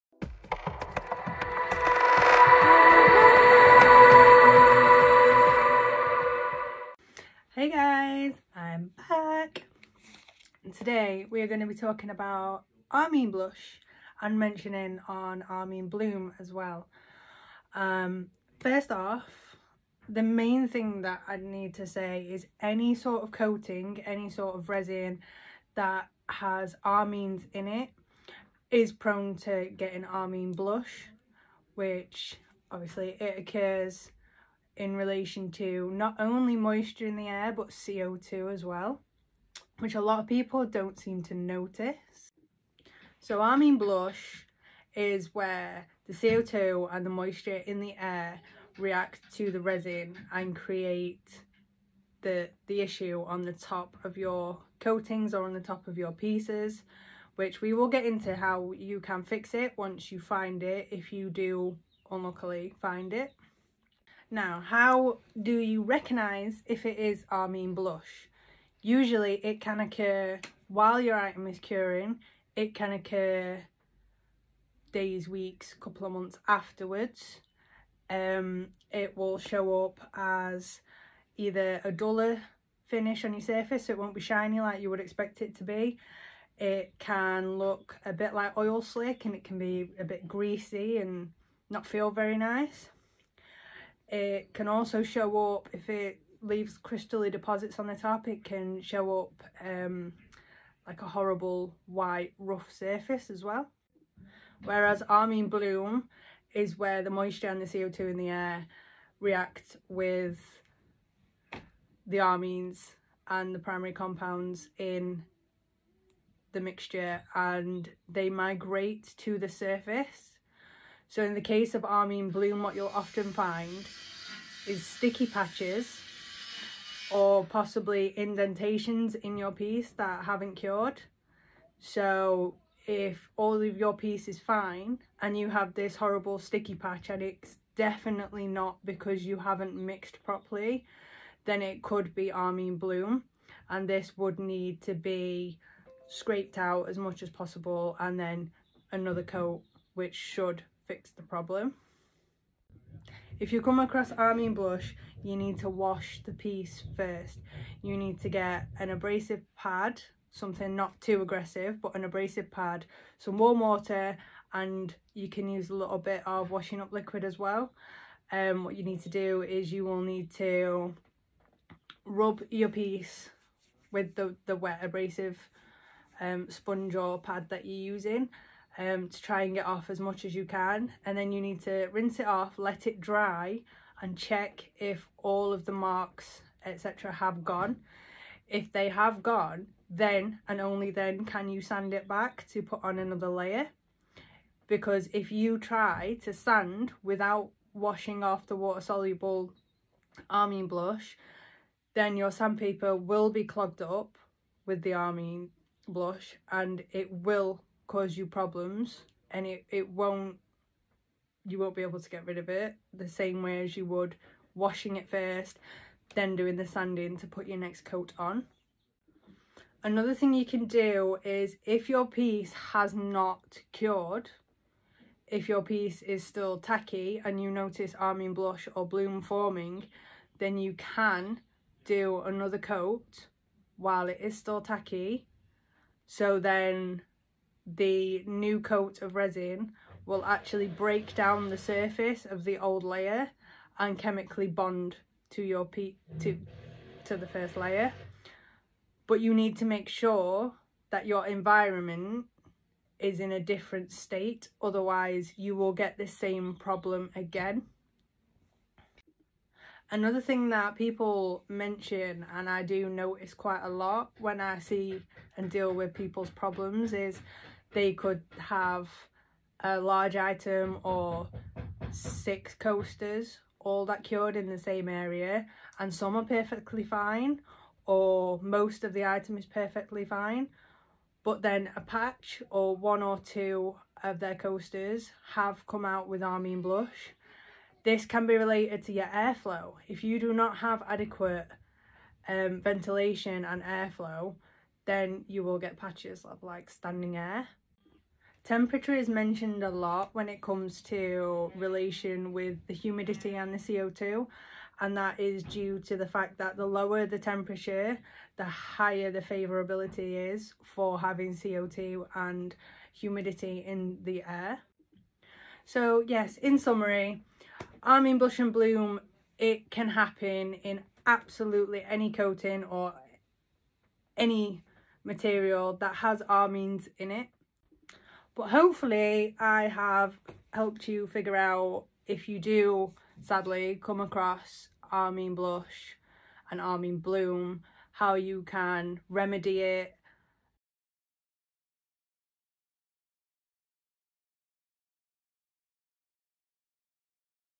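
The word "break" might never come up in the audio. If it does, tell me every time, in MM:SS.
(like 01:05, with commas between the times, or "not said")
04:00.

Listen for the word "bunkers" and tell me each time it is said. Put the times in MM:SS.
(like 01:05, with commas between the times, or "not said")
not said.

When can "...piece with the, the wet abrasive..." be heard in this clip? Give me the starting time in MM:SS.
02:52.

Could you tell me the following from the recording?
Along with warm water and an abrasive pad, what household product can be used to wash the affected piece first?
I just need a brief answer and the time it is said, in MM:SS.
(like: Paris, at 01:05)
washing up liquid, at 02:46.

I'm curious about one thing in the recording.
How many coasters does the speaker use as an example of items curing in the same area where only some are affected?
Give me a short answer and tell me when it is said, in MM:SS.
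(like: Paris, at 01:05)
6, at 04:31.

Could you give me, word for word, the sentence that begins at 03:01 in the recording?
And then you need to rinse it off, let it dry and check if all of the marks, etc.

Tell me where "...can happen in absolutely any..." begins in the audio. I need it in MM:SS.
05:19.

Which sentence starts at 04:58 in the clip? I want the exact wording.
Temperature is mentioned a lot when it comes to relation with the humidity mm.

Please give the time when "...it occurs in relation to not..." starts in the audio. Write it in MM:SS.
00:33.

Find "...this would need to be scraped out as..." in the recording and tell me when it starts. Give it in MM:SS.
02:23.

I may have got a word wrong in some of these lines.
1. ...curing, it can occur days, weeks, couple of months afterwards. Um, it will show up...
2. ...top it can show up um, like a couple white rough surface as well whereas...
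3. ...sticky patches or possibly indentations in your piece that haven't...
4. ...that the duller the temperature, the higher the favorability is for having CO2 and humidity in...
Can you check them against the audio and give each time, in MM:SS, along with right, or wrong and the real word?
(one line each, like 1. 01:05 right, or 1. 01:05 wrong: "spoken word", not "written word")
1. 01:11 right
2. 01:37 wrong: "horrible", not "couple"
3. 02:04 right
4. 05:06 wrong: "lower", not "duller".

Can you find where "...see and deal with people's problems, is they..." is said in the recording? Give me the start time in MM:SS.
04:24.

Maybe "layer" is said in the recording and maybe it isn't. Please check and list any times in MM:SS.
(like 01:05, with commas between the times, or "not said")
03:13, 04:02, 04:07.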